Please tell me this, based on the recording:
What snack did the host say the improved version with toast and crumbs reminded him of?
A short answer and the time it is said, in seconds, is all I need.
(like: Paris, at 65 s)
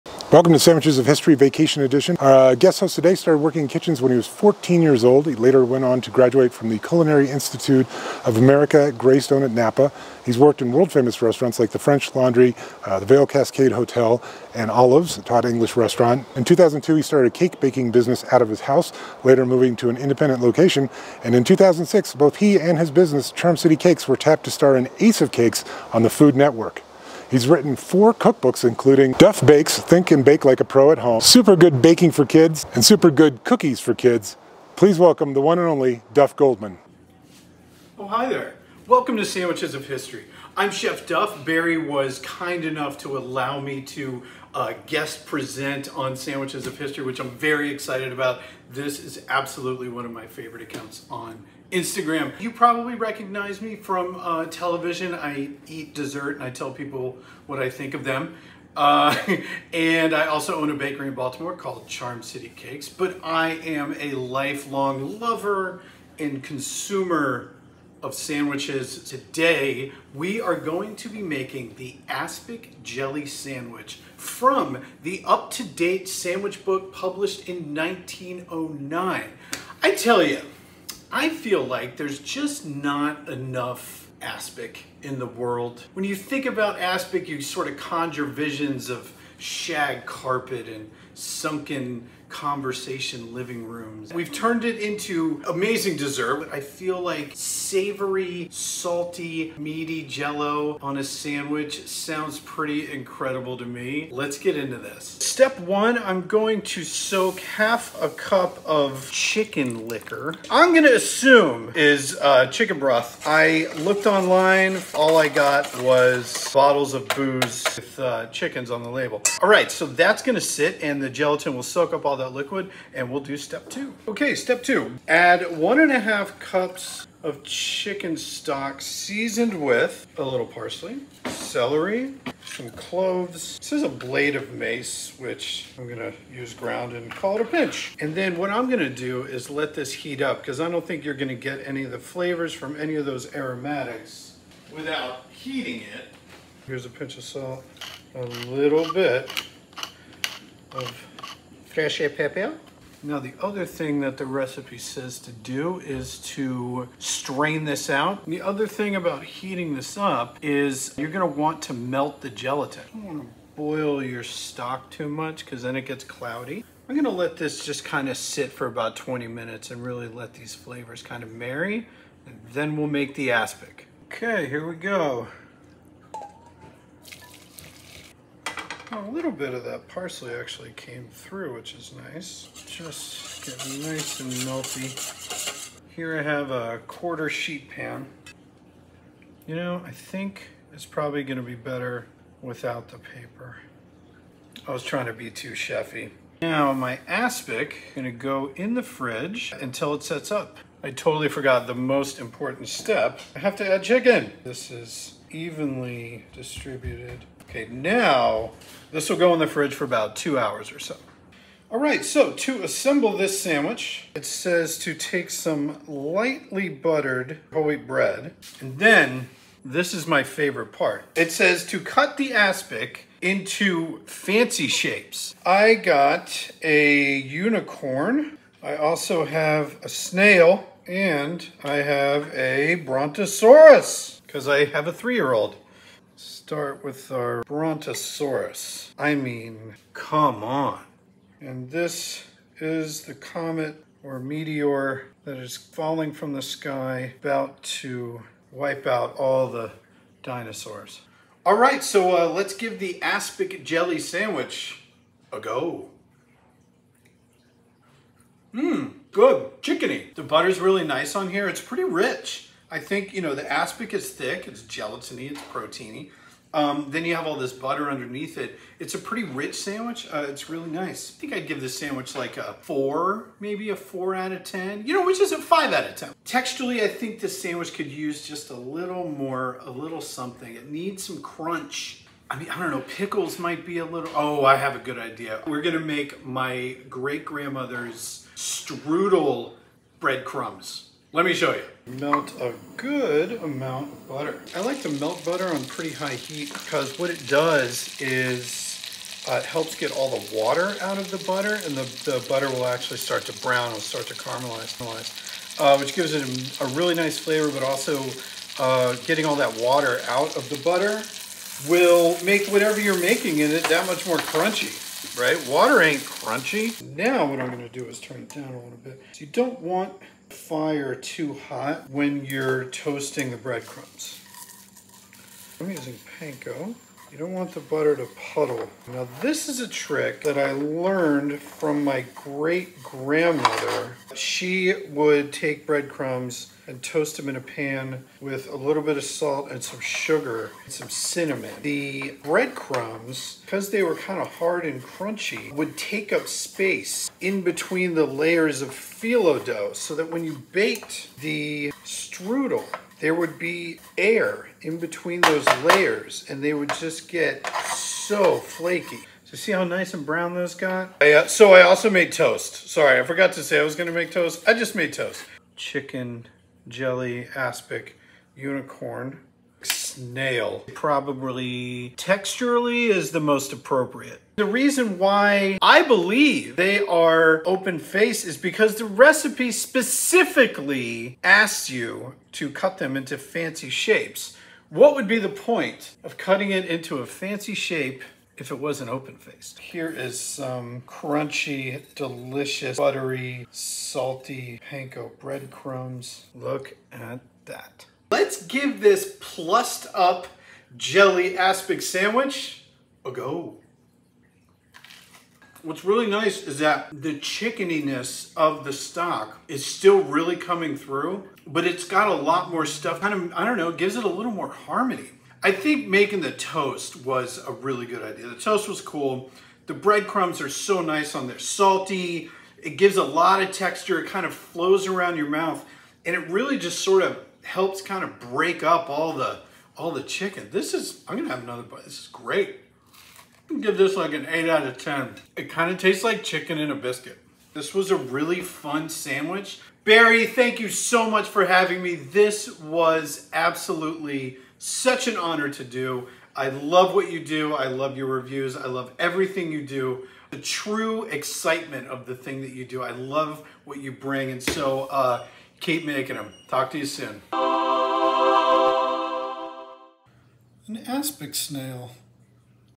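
chicken in a biscuit, at 436 s.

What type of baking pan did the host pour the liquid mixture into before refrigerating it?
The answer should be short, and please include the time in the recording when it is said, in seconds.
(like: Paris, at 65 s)
quarter sheet pan, at 186 s.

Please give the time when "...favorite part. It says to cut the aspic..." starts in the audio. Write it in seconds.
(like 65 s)
220 s.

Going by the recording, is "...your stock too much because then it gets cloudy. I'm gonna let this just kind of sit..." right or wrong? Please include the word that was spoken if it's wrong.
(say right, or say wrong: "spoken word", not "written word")
right.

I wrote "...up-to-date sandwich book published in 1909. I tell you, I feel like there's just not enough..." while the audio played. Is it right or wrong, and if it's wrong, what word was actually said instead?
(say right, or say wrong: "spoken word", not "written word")
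right.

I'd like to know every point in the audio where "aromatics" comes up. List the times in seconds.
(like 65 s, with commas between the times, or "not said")
143 s.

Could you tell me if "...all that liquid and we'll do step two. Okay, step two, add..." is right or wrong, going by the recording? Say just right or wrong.
right.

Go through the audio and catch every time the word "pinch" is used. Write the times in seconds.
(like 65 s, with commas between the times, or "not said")
137 s, 146 s.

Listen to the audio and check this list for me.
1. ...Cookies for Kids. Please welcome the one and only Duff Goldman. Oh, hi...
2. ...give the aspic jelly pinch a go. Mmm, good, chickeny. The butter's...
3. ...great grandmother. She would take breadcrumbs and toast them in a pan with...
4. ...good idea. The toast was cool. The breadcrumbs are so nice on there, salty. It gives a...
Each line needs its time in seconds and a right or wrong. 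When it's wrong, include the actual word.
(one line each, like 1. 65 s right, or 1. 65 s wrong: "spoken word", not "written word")
1. 33 s right
2. 252 s wrong: "sandwich", not "pinch"
3. 332 s right
4. 417 s right.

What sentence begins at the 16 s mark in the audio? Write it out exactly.
In 2002, he started a cake baking business out of his house, later moving to an independent location.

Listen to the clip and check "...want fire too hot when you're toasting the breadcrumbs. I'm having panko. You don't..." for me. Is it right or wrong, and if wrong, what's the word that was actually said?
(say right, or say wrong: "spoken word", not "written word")
wrong: "using", not "having".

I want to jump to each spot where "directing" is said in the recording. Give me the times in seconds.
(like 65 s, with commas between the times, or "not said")
not said.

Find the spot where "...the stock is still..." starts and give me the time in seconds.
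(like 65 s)
408 s.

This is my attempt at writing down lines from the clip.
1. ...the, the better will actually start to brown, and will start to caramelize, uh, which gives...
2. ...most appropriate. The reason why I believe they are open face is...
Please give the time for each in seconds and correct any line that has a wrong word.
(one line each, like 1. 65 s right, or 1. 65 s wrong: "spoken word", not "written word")
1. 301 s wrong: "butter", not "better"
2. 373 s right.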